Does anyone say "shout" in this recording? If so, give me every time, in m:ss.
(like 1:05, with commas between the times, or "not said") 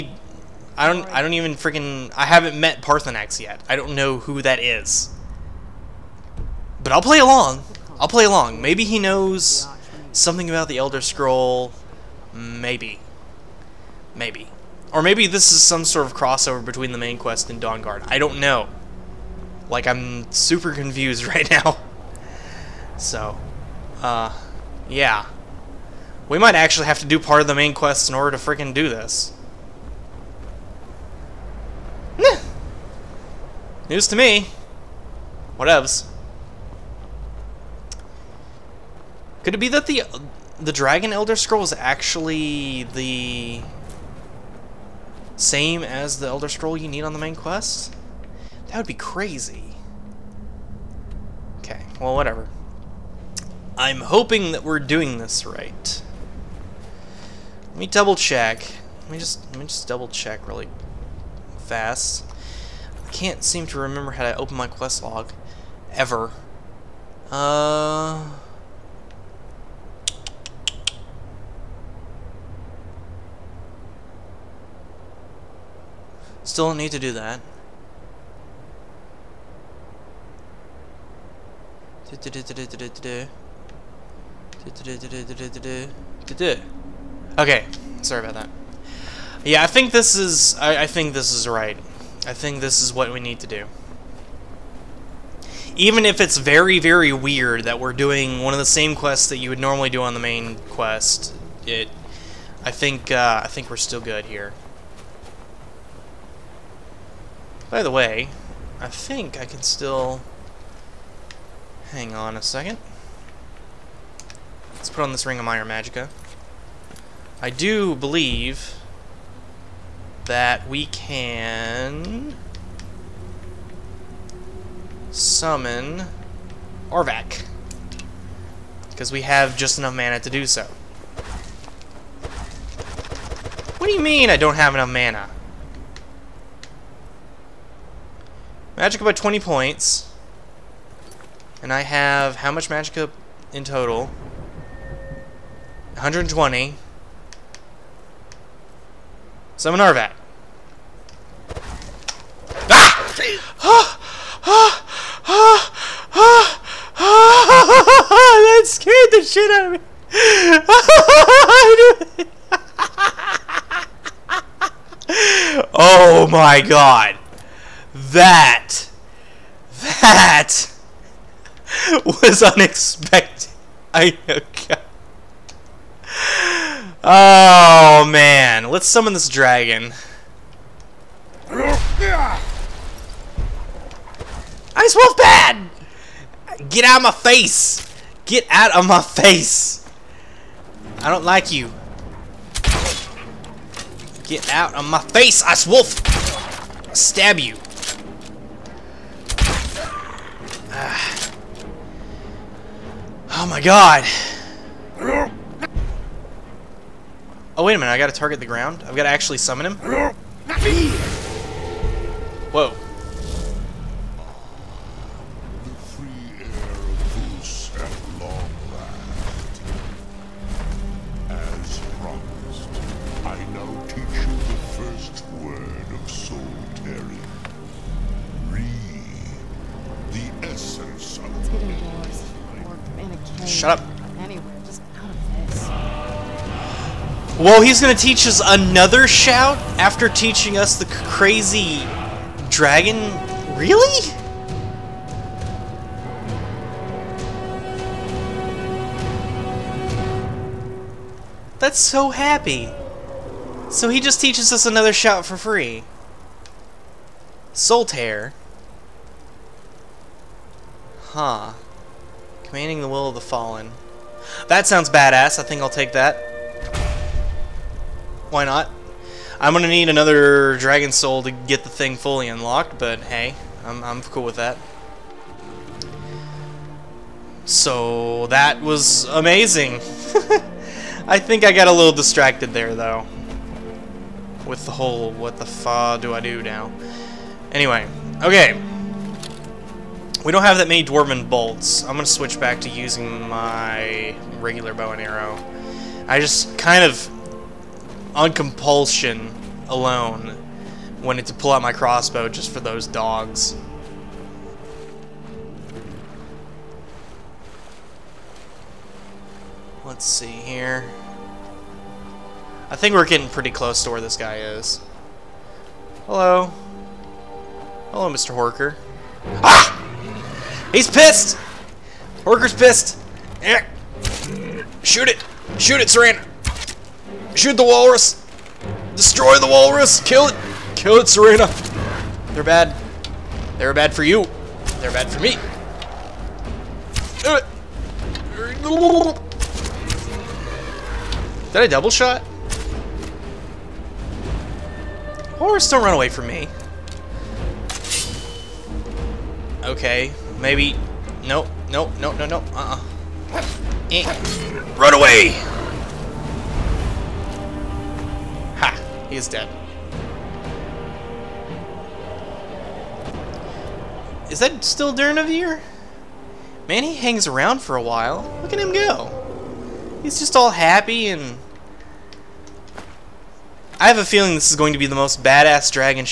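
3:59, 4:14.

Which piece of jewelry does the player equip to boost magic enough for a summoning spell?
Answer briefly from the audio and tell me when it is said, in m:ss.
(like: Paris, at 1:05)
Ring of Minor Magicka, at 1:55.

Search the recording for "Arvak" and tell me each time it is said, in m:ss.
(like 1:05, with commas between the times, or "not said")
2:06, 2:29.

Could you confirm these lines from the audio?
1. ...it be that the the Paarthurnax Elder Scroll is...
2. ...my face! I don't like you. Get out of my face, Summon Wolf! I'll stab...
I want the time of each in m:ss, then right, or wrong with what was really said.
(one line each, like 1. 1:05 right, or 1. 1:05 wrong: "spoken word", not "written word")
1. 0:39 wrong: "Dragon", not "Paarthurnax"
2. 3:08 wrong: "Ice", not "Summon".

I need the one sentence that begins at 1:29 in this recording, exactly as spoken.
Yeah, I think this is, I, I think this is right.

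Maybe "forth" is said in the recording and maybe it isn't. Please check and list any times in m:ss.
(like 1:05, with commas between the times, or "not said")
not said.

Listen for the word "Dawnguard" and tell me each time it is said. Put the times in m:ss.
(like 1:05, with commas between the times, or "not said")
0:17.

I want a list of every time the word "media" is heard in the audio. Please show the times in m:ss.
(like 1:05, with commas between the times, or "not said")
not said.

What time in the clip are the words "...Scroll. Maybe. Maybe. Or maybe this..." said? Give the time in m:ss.
0:11.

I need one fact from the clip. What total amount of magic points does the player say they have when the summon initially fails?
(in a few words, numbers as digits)
120.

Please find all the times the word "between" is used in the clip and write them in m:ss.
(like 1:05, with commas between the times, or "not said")
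0:16.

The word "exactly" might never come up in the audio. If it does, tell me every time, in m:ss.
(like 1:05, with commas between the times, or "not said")
not said.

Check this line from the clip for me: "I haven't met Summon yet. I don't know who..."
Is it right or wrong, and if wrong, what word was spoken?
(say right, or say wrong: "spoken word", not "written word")
wrong: "Paarthurnax", not "Summon".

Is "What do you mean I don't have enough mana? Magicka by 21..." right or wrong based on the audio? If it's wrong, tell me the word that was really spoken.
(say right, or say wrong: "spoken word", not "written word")
wrong: "20", not "21".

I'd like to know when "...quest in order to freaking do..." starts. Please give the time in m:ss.
0:27.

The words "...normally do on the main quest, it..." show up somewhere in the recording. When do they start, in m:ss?
1:39.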